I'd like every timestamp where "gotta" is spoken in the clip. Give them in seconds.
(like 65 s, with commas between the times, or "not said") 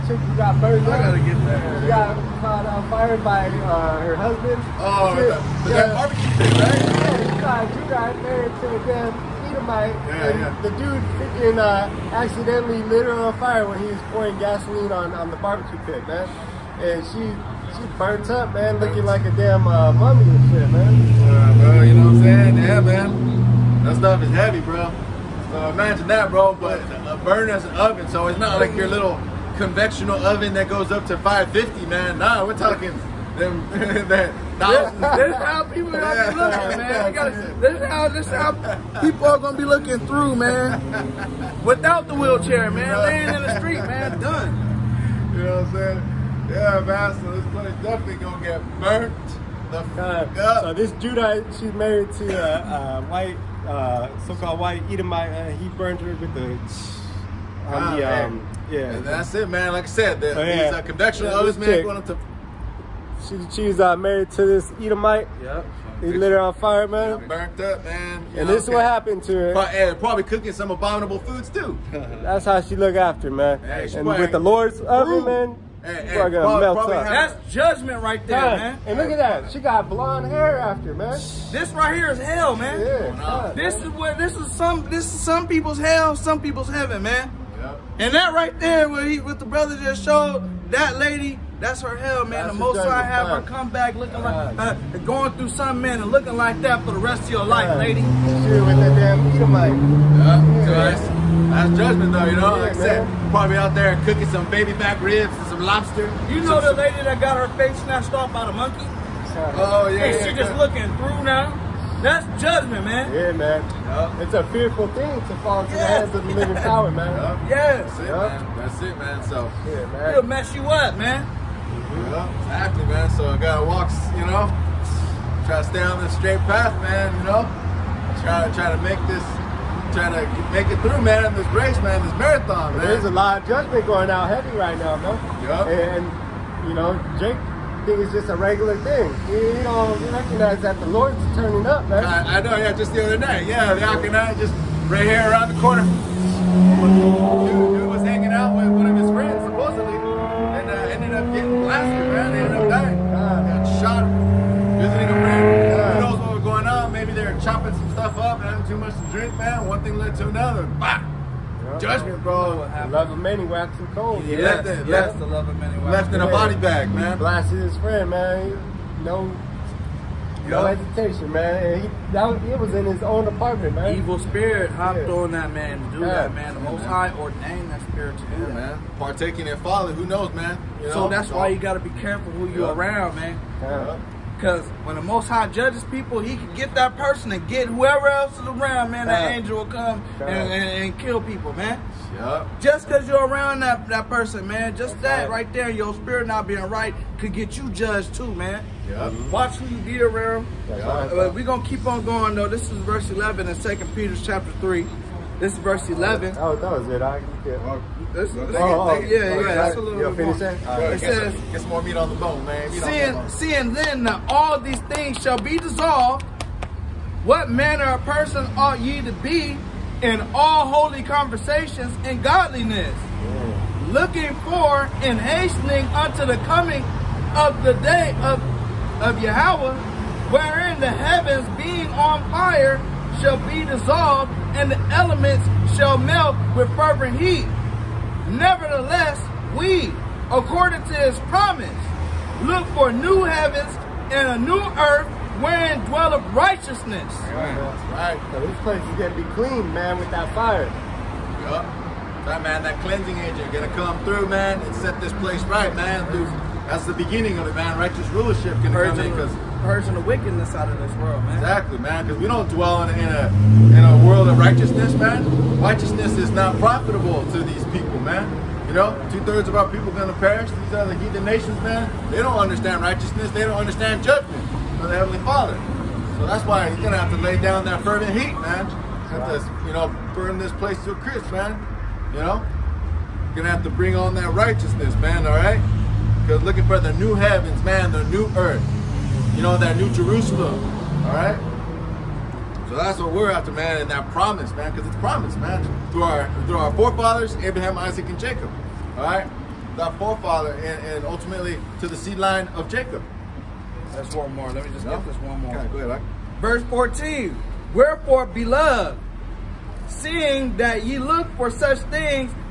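1 s, 37 s, 123 s.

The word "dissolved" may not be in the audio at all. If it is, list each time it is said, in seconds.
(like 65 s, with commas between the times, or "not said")
215 s, 233 s.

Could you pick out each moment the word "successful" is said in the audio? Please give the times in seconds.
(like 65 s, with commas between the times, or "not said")
not said.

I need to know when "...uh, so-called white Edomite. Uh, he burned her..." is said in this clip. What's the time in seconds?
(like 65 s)
53 s.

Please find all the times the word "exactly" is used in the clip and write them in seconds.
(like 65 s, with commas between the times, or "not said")
122 s, 261 s.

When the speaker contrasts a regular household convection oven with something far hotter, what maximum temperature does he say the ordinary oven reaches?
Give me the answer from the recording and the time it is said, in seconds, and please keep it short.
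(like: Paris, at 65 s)
550, at 31 s.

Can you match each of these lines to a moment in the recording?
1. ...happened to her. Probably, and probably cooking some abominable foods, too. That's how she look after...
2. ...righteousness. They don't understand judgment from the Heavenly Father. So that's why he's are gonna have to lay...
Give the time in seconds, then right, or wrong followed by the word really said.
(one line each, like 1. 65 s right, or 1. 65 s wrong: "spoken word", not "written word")
1. 68 s right
2. 272 s right.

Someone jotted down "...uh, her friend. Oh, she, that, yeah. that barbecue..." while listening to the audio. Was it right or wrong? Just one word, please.
wrong.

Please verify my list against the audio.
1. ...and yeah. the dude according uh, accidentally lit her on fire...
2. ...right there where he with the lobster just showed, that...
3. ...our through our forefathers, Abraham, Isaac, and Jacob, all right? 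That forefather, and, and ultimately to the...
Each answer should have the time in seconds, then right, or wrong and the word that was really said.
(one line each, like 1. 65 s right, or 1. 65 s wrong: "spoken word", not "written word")
1. 10 s wrong: "freaking", not "according"
2. 88 s wrong: "brother", not "lobster"
3. 296 s right.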